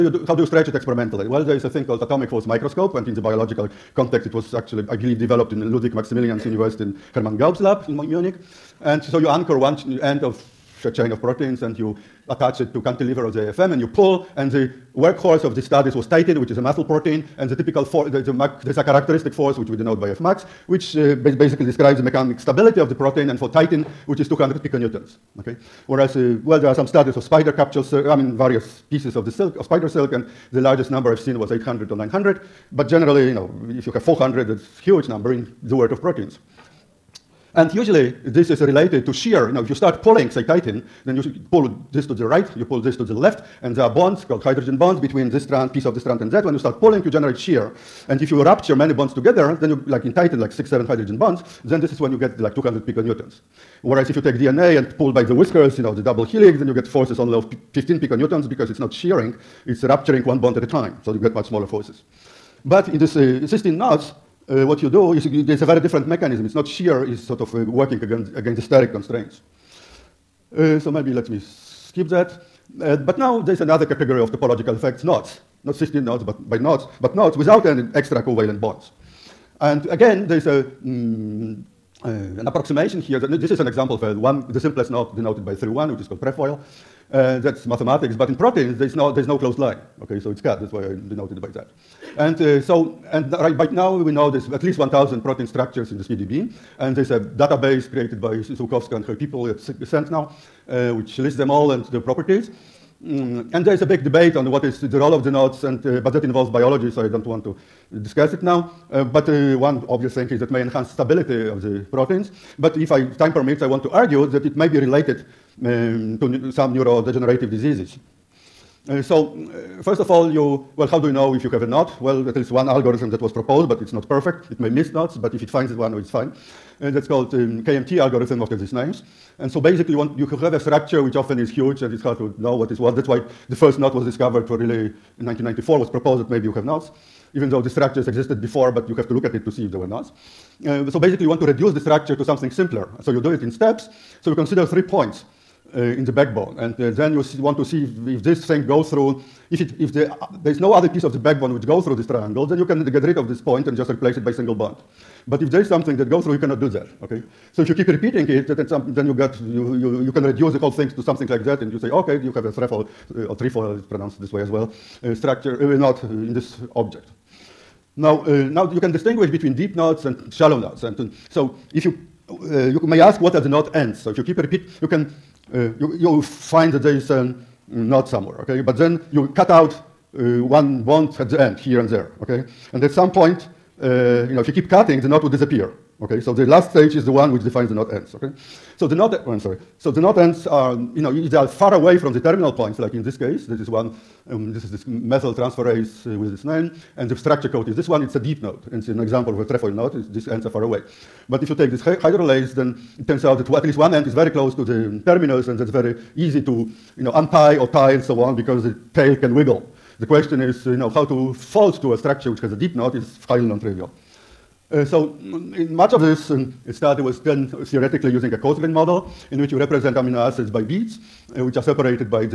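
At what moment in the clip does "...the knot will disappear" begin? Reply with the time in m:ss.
3:05.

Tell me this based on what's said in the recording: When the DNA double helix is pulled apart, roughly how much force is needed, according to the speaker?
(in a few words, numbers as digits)
15 piconewtons.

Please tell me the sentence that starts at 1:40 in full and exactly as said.
Uh, which lists them all and the properties.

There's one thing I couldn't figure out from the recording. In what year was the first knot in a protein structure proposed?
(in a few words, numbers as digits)
1994.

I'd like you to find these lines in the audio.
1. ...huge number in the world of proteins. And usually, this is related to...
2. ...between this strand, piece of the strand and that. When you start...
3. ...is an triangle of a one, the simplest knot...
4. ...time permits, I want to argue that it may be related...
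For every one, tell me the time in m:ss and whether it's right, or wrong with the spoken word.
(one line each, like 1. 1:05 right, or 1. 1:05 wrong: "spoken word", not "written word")
1. 0:34 right
2. 0:45 right
3. 1:23 wrong: "example", not "triangle"
4. 1:53 right.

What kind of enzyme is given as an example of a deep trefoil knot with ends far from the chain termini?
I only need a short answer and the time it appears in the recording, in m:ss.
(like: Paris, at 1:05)
methyl transferase, at 3:14.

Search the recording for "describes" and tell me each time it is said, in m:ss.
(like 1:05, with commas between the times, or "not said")
0:21.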